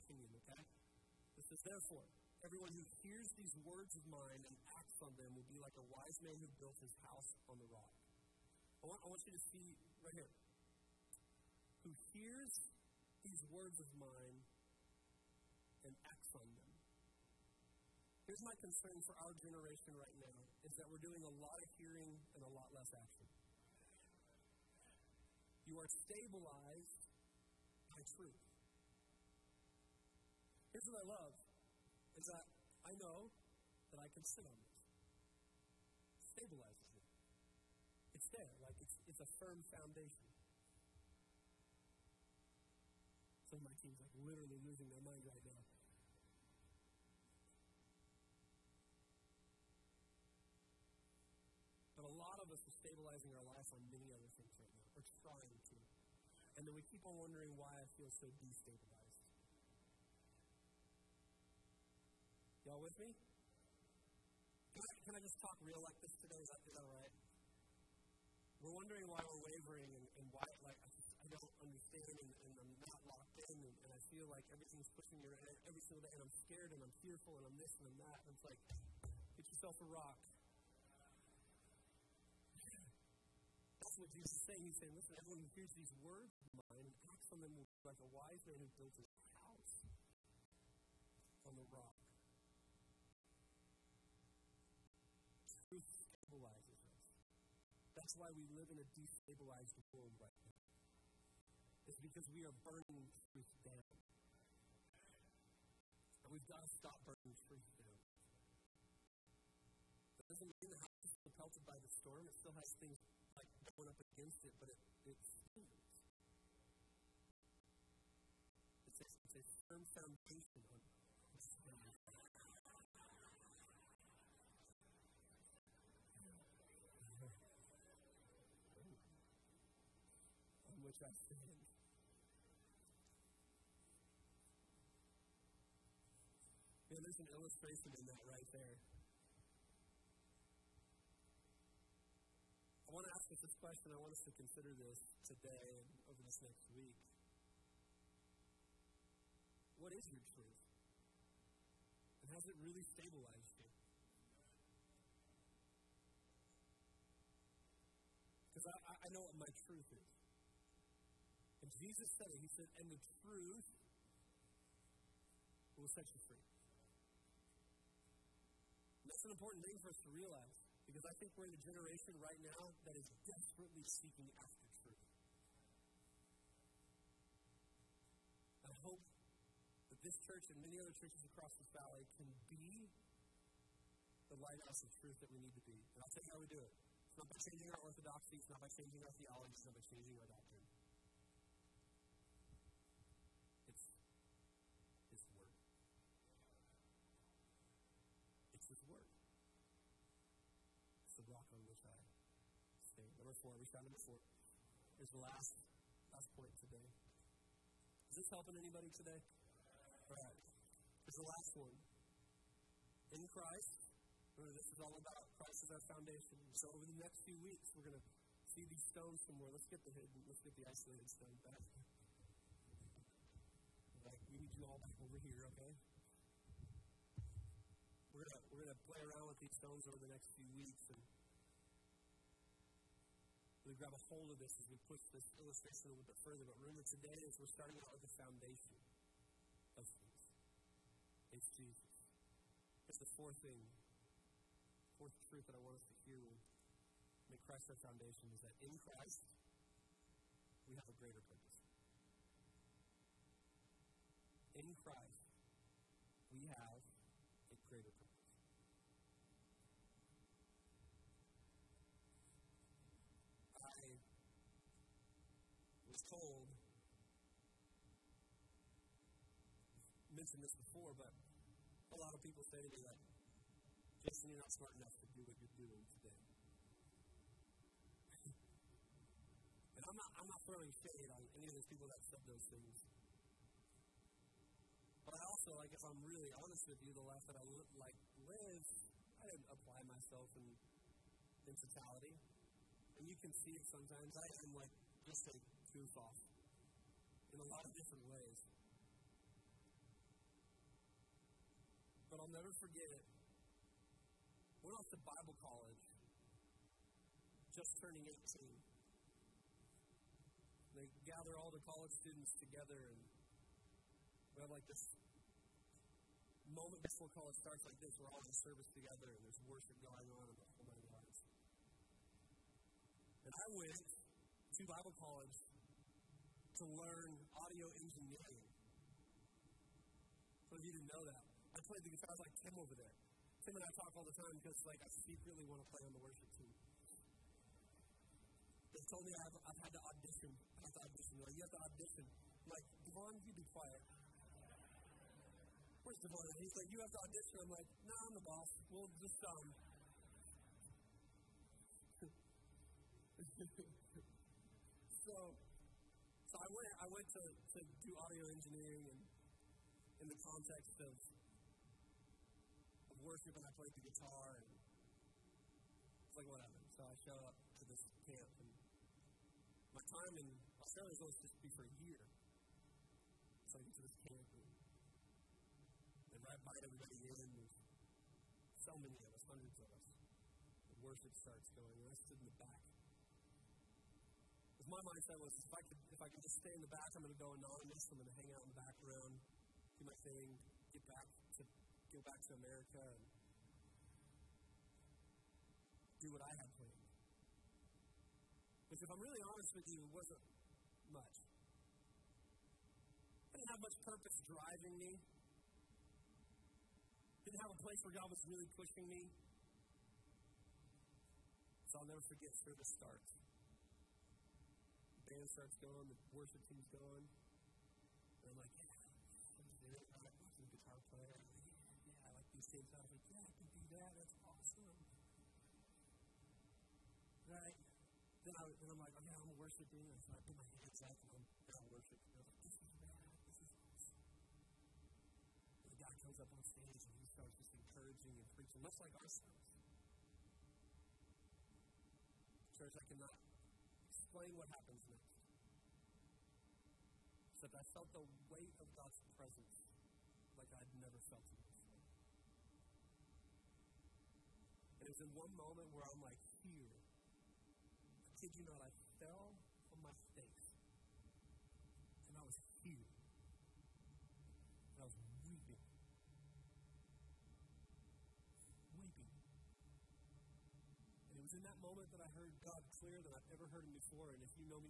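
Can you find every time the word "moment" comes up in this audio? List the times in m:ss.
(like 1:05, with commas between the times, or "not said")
5:16, 7:35, 7:51.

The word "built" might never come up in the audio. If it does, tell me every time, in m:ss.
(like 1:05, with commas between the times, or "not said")
0:06, 1:28.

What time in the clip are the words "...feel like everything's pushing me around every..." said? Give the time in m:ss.
1:14.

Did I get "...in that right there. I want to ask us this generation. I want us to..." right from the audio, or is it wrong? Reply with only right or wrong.
wrong.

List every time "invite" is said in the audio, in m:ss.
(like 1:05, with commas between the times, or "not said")
6:16.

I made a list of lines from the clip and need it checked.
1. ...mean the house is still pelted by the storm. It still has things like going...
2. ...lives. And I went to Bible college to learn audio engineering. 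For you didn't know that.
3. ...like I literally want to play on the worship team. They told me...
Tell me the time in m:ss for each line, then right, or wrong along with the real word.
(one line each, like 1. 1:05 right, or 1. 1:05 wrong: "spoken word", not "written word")
1. 1:50 right
2. 5:20 right
3. 5:34 wrong: "secretly", not "literally".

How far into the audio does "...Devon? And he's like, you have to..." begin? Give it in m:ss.
5:46.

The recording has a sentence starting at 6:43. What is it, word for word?
I didn't have much purpose driving me.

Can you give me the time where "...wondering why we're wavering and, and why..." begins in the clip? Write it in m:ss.
1:08.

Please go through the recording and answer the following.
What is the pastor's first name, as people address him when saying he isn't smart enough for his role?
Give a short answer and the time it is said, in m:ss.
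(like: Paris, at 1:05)
Jason, at 4:34.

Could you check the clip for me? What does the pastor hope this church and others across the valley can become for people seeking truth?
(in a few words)
lighthouse of truth.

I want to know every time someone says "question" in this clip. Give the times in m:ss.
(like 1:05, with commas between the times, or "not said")
2:23.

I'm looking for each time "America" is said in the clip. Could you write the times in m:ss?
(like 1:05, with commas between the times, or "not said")
6:32.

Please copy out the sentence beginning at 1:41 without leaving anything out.
It's because we are burning truth down.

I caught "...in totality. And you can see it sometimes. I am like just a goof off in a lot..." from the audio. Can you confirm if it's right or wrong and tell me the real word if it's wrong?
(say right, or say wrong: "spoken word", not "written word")
right.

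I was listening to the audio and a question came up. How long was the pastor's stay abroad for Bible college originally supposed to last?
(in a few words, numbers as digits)
a year.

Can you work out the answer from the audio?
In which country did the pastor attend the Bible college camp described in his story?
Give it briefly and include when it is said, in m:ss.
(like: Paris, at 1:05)
Australia, at 6:10.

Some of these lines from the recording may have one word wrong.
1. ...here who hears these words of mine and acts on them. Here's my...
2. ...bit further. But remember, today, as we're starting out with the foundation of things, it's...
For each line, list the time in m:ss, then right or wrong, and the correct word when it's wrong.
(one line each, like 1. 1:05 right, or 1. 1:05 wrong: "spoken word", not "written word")
1. 0:10 right
2. 3:56 right.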